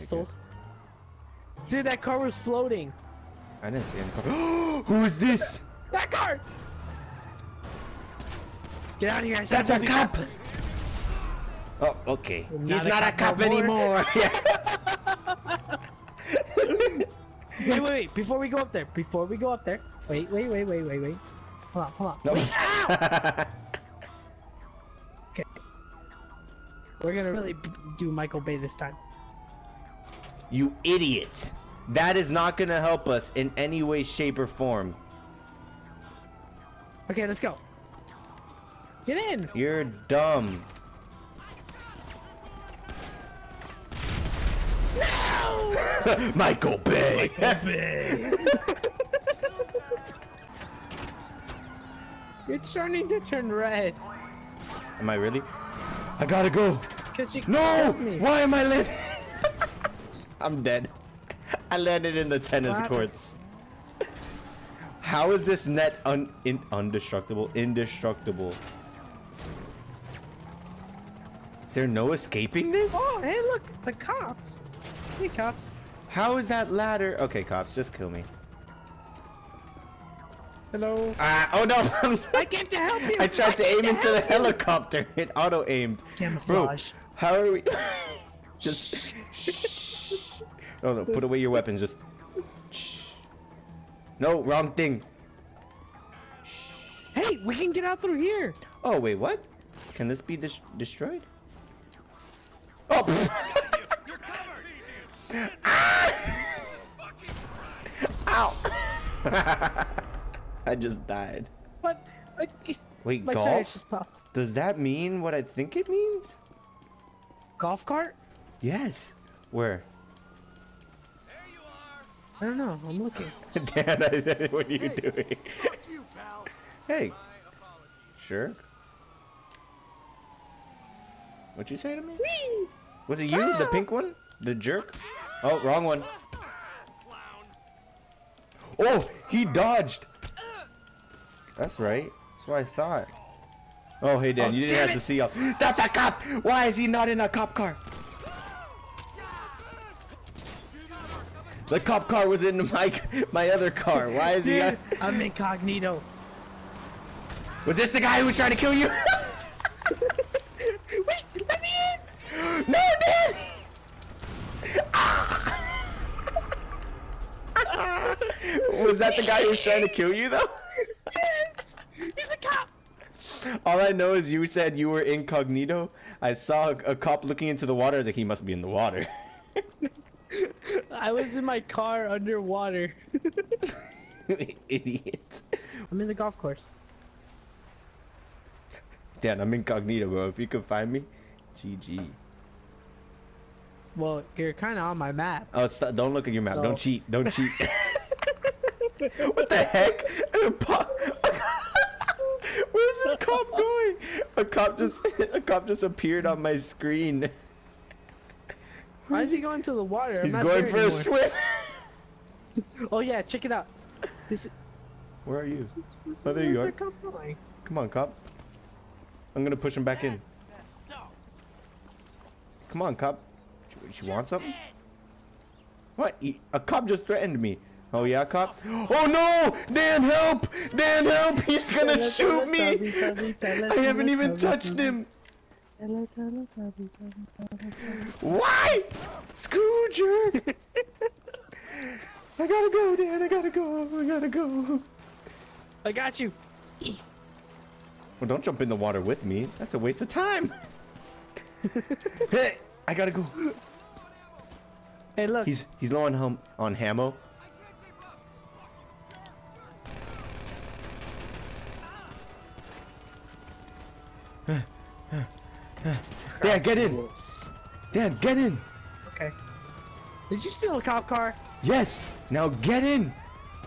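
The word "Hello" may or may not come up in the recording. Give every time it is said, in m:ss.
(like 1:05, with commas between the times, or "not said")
1:20.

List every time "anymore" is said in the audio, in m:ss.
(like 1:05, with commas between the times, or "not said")
0:13, 3:30.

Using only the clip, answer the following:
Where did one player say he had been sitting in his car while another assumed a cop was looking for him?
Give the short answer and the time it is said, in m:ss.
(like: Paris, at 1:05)
underwater, at 3:02.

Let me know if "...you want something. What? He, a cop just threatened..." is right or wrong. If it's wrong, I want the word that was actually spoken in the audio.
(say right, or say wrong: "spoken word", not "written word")
right.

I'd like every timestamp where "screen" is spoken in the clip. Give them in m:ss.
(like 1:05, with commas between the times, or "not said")
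3:26.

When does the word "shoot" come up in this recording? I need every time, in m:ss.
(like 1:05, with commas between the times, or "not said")
3:52.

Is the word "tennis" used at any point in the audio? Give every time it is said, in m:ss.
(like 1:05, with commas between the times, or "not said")
1:02.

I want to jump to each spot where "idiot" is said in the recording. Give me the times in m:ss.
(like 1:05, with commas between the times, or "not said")
0:30, 3:04.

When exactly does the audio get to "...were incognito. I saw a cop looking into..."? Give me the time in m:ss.
2:54.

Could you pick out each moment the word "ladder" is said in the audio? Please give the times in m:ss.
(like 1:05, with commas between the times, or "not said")
1:16.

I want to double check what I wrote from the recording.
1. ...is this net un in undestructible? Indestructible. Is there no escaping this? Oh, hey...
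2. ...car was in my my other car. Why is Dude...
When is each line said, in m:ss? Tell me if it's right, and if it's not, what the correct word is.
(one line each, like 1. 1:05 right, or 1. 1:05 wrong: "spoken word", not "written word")
1. 1:05 right
2. 2:32 right.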